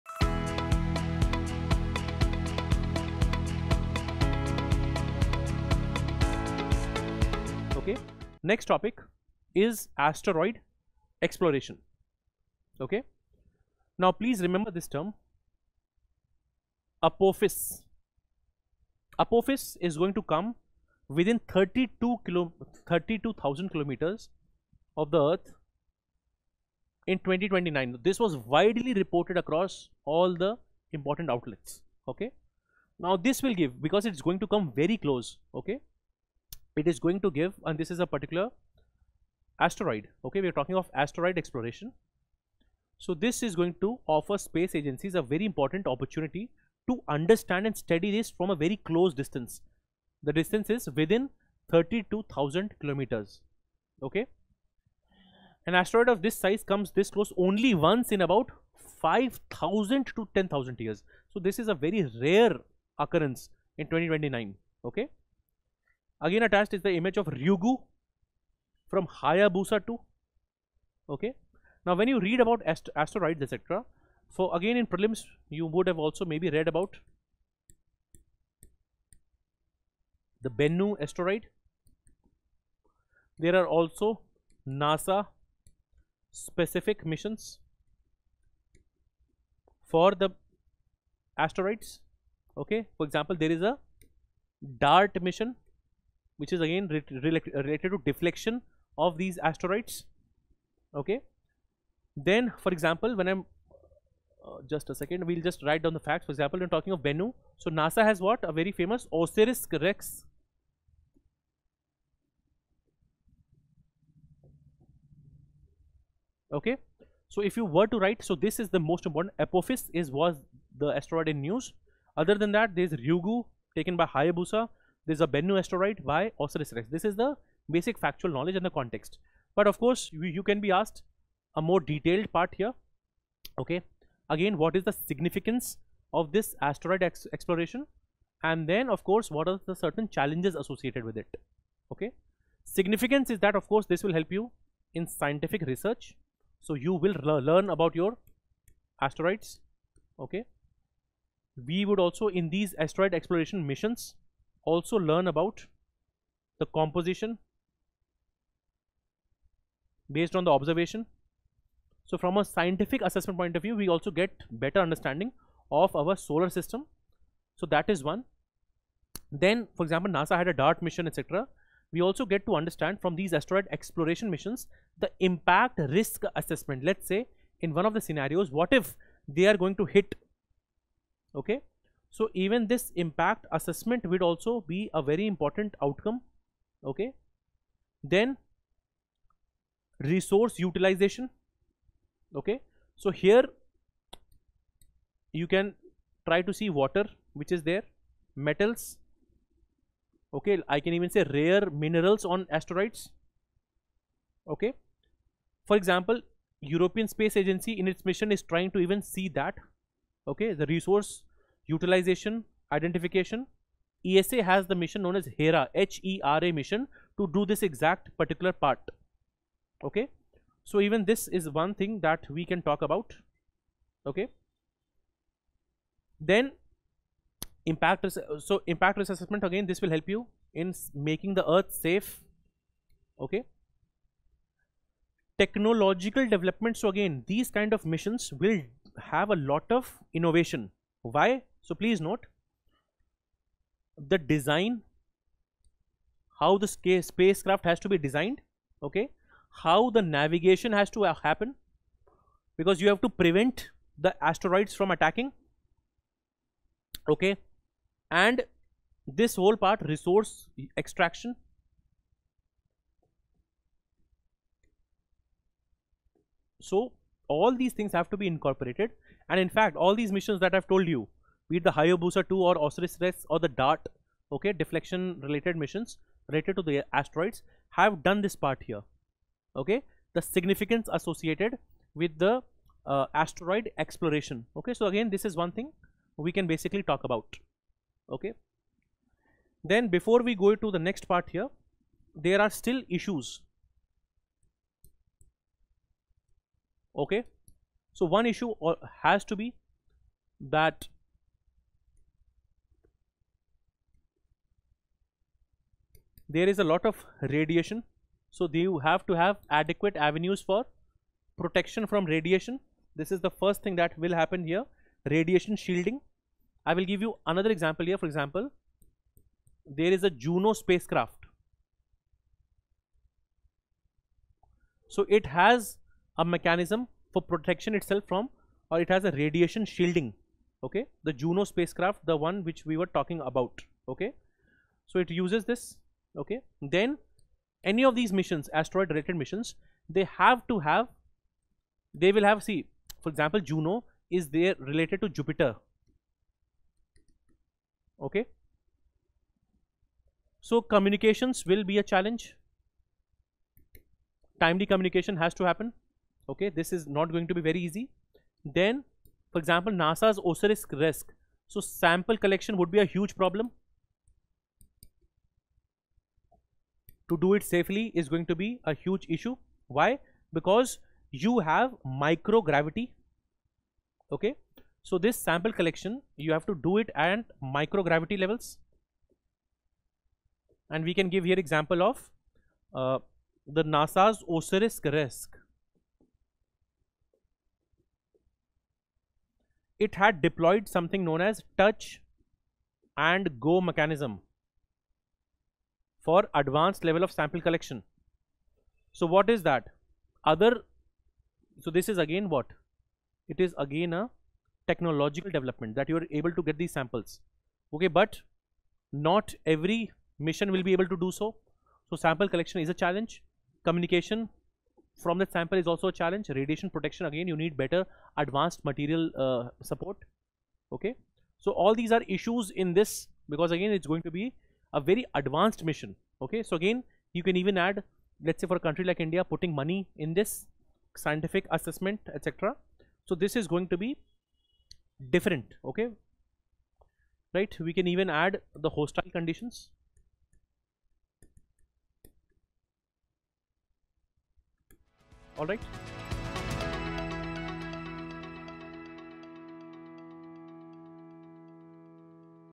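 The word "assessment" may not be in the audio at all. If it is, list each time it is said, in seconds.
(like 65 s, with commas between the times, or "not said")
163 s, 176 s, 183 s, 229 s, 431 s.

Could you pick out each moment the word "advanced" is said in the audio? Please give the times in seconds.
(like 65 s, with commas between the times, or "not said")
396 s, 418 s, 425 s.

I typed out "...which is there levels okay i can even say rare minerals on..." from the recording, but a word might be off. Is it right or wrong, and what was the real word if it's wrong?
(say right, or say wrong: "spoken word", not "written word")
wrong: "metals", not "levels".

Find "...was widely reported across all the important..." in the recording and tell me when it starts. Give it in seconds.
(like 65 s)
28 s.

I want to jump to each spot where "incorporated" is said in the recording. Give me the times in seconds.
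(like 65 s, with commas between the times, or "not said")
268 s.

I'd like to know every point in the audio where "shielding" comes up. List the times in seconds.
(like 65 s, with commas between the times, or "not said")
315 s, 329 s.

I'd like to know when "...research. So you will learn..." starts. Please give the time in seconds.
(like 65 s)
145 s.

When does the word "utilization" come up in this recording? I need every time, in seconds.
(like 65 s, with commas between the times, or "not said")
190 s, 211 s.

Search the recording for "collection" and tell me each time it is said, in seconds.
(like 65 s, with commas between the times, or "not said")
362 s, 375 s, 397 s, 412 s.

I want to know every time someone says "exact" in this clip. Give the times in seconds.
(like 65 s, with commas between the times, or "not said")
217 s.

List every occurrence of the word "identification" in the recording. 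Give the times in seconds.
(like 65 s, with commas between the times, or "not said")
212 s.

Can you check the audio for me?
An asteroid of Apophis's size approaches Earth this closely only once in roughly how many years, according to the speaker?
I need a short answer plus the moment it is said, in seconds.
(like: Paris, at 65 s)
5000 to 10000 years, at 59 s.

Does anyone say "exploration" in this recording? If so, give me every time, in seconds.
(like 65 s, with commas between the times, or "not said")
11 s, 41 s, 137 s, 153 s, 173 s, 283 s.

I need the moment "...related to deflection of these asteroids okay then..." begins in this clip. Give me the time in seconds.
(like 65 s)
97 s.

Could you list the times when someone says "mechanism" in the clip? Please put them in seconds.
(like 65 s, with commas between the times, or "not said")
326 s, 393 s.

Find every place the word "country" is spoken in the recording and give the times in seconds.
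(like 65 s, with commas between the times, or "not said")
428 s.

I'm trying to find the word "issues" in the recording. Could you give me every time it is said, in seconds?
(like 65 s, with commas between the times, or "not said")
292 s, 298 s, 369 s, 422 s.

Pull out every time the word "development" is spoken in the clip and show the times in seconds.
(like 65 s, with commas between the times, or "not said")
236 s, 405 s.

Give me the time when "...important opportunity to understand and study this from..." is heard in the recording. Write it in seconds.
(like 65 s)
45 s.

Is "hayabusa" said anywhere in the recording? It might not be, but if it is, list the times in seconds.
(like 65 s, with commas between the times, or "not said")
69 s, 124 s, 271 s.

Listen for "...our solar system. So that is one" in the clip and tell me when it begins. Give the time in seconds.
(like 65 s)
165 s.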